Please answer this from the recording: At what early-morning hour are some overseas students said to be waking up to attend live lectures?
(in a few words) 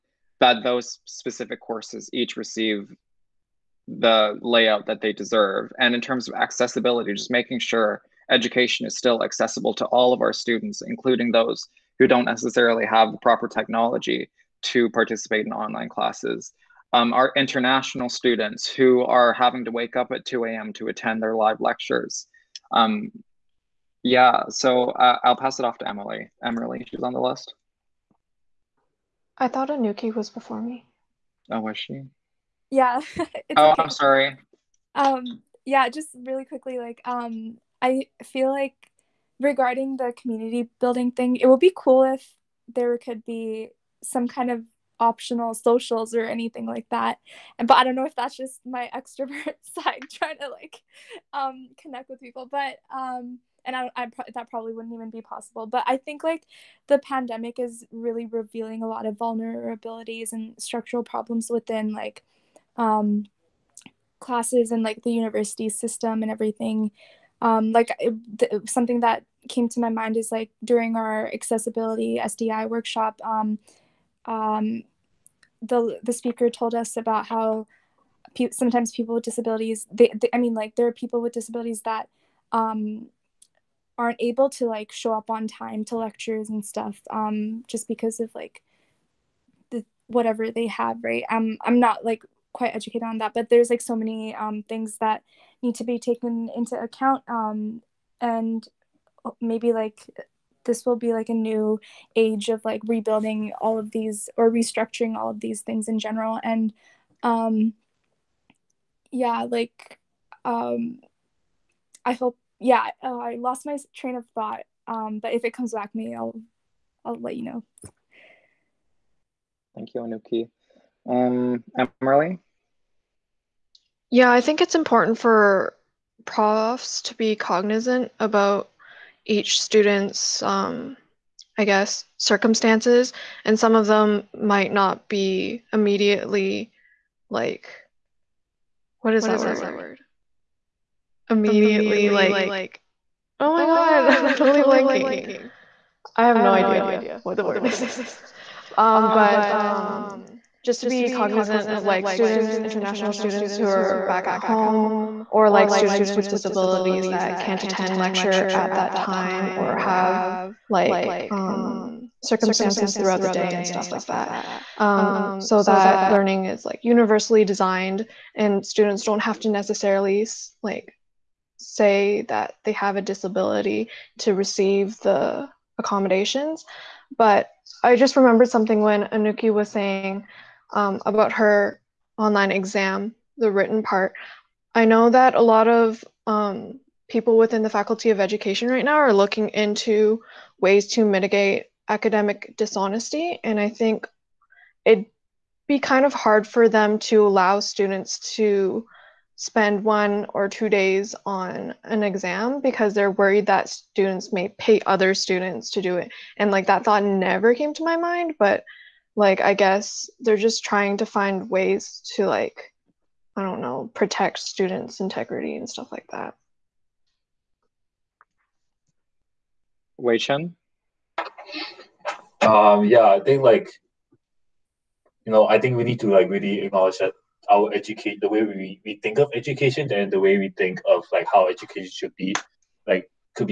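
2 a.m.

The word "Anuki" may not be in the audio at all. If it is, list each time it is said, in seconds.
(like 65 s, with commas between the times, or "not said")
29 s, 120 s, 179 s.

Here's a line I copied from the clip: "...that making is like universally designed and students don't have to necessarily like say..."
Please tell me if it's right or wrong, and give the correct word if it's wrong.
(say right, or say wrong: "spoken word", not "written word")
wrong: "learning", not "making".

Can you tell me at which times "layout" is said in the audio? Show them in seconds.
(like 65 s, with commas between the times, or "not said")
4 s.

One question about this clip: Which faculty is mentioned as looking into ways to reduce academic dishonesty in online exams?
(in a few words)
Faculty of Education.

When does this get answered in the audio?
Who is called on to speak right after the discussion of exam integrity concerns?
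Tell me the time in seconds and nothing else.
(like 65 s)
219 s.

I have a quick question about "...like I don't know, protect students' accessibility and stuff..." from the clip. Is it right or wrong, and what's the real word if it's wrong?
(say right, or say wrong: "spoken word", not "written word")
wrong: "integrity", not "accessibility".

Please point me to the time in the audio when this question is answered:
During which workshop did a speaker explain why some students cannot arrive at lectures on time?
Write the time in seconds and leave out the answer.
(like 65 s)
71 s.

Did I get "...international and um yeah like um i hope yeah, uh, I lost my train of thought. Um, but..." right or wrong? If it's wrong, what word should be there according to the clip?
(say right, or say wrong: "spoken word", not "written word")
wrong: "general", not "international".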